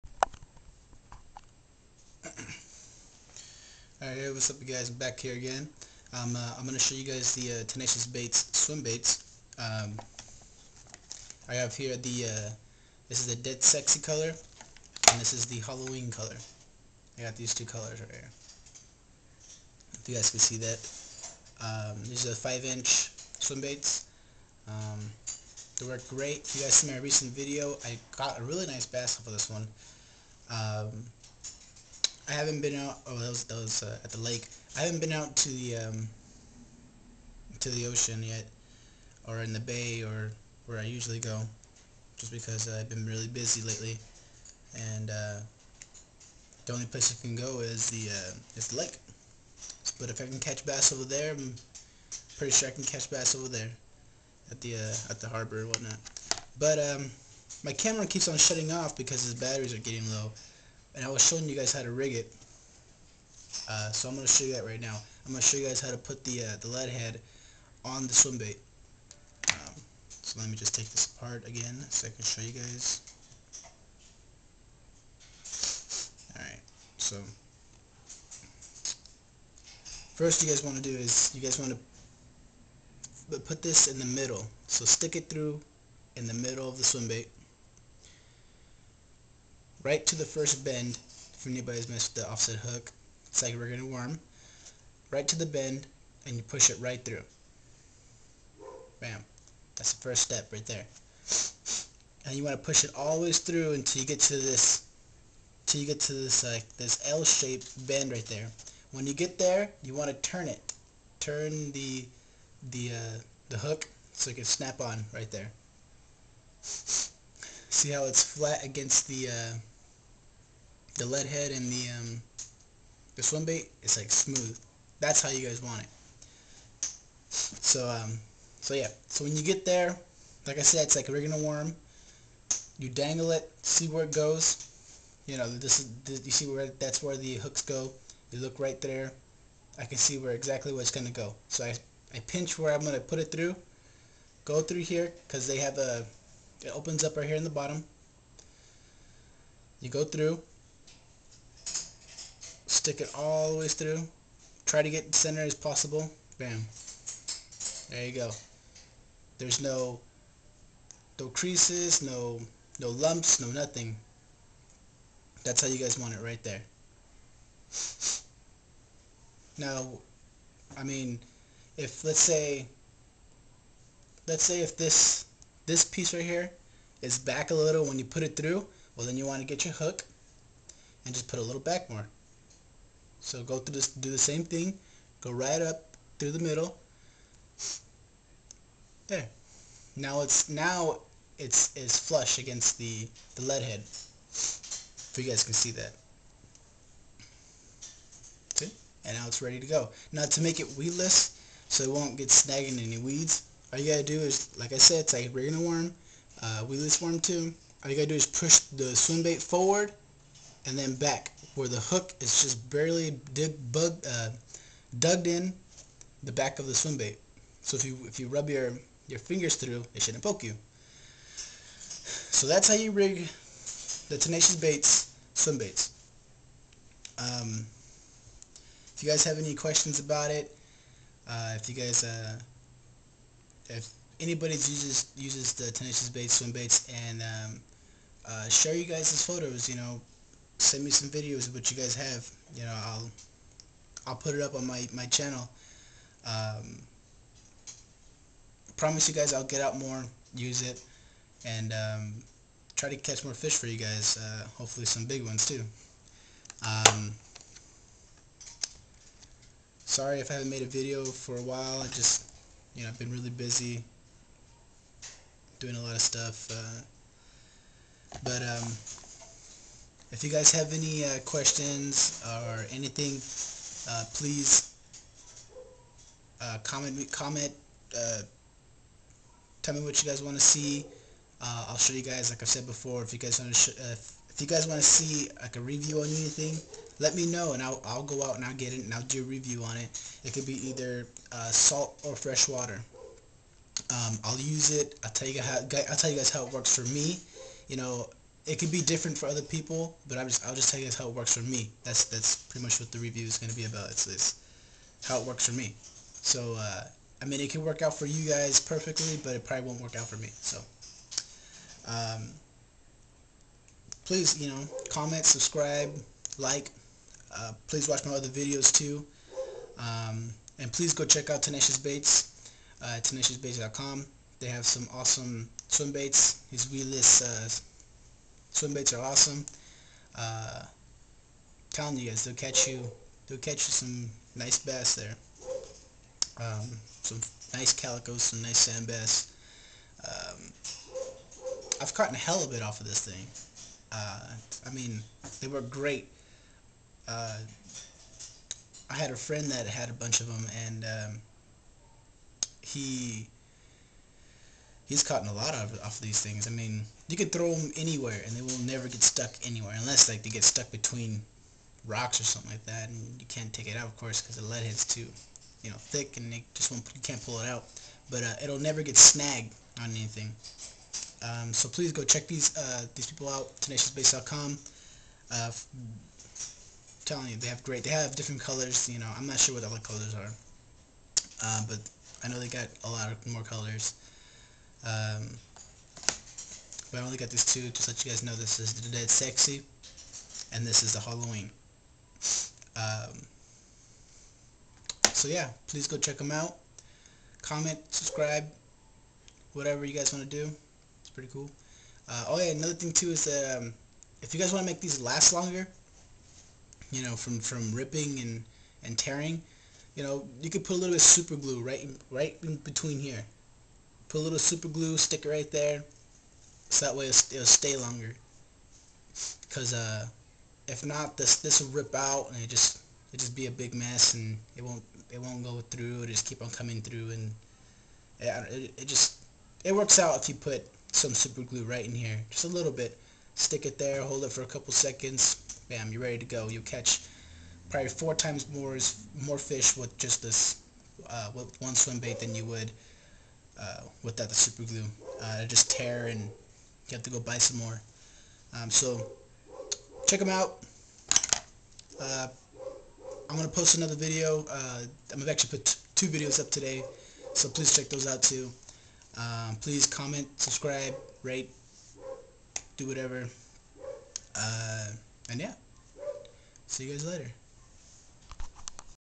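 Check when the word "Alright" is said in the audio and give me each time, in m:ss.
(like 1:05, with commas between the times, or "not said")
0:04, 1:16.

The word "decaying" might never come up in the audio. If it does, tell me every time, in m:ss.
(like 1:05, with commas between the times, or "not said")
not said.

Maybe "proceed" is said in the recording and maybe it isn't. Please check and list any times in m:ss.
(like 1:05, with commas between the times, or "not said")
not said.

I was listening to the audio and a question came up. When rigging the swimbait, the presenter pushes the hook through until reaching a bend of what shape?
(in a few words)
L-shaped.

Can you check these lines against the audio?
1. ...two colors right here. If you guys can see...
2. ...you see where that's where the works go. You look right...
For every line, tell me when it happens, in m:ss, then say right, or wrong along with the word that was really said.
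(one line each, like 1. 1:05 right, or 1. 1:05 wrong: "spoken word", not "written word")
1. 0:17 right
2. 2:16 wrong: "hooks", not "works".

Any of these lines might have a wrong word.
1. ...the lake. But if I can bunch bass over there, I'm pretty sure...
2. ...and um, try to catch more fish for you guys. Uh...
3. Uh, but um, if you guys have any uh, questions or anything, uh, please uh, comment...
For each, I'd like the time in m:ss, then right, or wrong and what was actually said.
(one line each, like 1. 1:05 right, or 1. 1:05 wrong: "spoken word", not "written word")
1. 0:48 wrong: "catch", not "bunch"
2. 4:11 right
3. 4:26 right.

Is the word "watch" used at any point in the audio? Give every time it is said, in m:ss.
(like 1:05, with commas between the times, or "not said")
5:17.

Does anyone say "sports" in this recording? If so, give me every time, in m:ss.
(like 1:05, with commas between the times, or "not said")
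not said.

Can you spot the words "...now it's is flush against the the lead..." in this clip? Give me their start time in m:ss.
3:10.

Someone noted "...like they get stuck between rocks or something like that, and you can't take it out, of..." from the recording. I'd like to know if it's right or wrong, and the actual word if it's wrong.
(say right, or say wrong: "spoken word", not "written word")
right.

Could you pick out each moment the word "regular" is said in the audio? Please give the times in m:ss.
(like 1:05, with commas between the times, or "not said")
3:25.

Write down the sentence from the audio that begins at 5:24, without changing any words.
They have some awesome swim baits.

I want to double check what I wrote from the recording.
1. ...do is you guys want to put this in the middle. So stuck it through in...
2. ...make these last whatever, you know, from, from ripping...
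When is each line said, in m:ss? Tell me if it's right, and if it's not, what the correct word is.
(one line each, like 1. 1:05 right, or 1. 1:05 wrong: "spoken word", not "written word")
1. 1:20 wrong: "stick", not "stuck"
2. 6:44 wrong: "longer", not "whatever".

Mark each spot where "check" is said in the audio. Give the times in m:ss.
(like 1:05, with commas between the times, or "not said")
5:21, 6:12, 6:35, 7:30, 7:37.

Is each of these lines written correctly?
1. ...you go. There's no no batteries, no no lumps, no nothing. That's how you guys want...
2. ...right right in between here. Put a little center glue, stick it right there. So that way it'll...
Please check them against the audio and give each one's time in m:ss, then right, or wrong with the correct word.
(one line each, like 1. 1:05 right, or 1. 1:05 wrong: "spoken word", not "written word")
1. 2:38 wrong: "creases", not "batteries"
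2. 6:51 wrong: "super", not "center".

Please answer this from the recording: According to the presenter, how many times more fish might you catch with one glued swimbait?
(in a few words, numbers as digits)
4 times.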